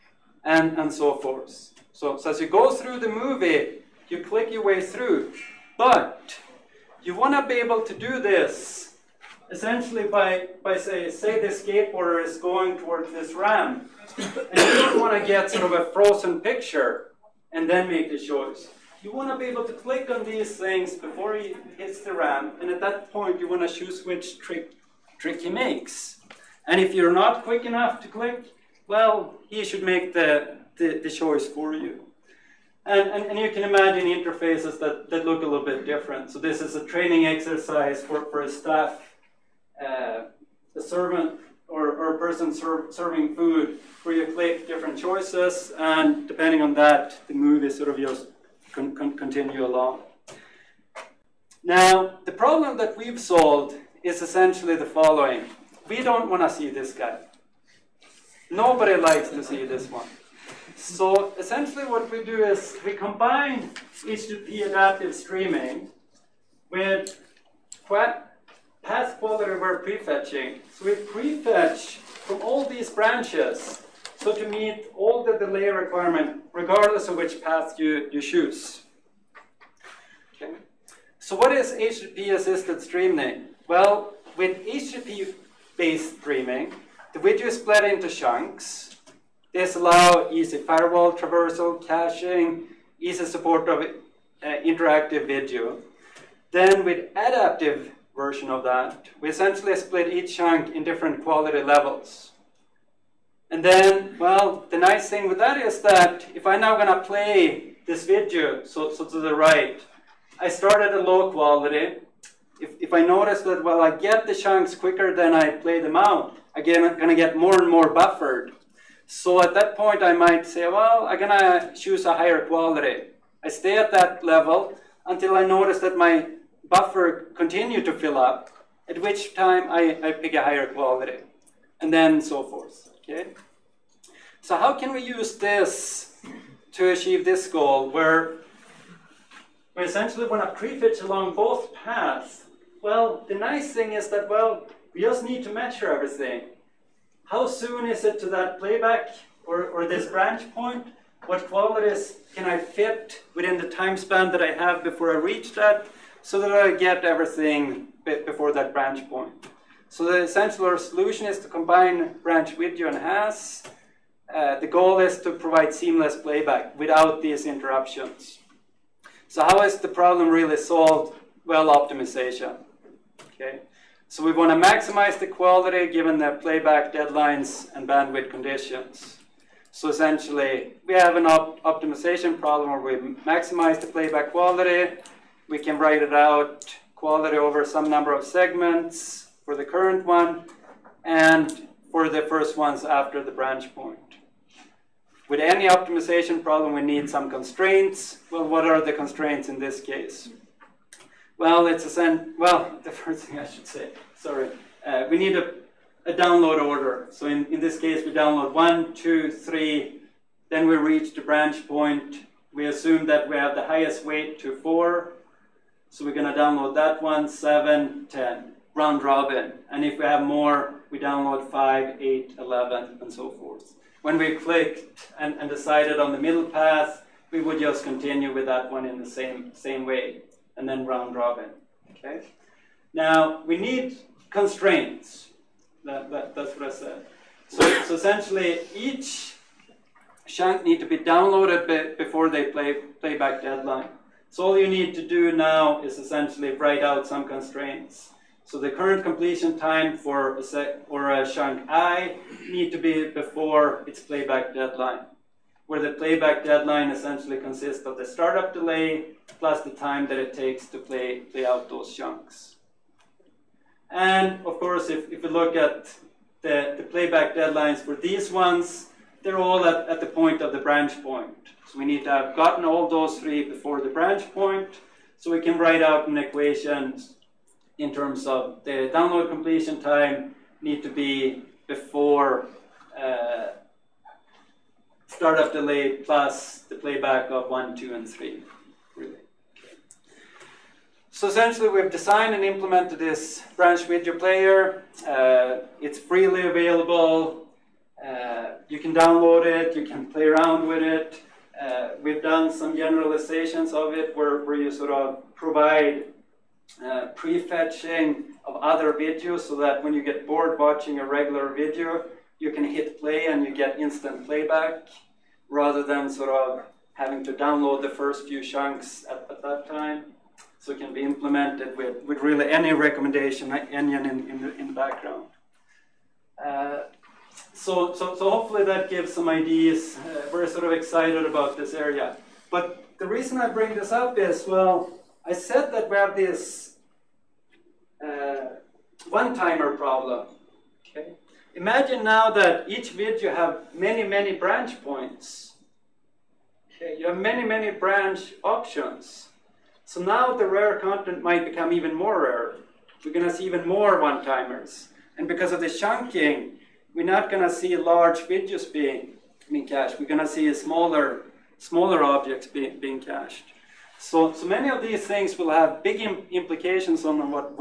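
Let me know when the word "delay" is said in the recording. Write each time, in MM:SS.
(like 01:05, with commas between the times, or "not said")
01:15, 04:18, 04:45.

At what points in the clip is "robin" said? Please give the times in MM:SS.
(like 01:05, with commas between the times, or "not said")
03:39, 03:51.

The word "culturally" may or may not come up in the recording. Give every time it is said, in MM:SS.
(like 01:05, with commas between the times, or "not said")
not said.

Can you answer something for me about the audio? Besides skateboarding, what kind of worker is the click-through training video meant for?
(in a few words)
a person serving food.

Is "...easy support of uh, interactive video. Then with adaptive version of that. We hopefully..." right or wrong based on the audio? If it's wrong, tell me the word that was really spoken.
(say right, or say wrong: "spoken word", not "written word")
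wrong: "essentially", not "hopefully".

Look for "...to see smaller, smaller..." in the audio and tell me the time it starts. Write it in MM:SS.
06:00.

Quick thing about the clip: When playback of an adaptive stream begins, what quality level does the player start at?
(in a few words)
low quality.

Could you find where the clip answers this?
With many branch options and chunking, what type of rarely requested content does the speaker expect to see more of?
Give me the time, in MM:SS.
05:53.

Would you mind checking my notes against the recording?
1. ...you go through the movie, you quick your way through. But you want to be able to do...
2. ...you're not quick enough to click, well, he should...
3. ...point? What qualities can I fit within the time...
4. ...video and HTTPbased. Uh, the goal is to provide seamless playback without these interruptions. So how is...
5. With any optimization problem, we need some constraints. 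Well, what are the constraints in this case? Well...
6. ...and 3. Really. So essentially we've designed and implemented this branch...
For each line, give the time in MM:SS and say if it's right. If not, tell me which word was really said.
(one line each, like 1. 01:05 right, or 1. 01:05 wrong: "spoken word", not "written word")
1. 00:02 wrong: "click", not "quick"
2. 00:26 right
3. 02:30 right
4. 02:42 wrong: "HAS", not "HTTPbased"
5. 03:15 right
6. 04:47 right.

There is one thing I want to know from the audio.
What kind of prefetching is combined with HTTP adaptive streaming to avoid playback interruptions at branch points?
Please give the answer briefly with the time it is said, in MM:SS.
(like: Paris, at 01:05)
quality aware prefetching, at 01:09.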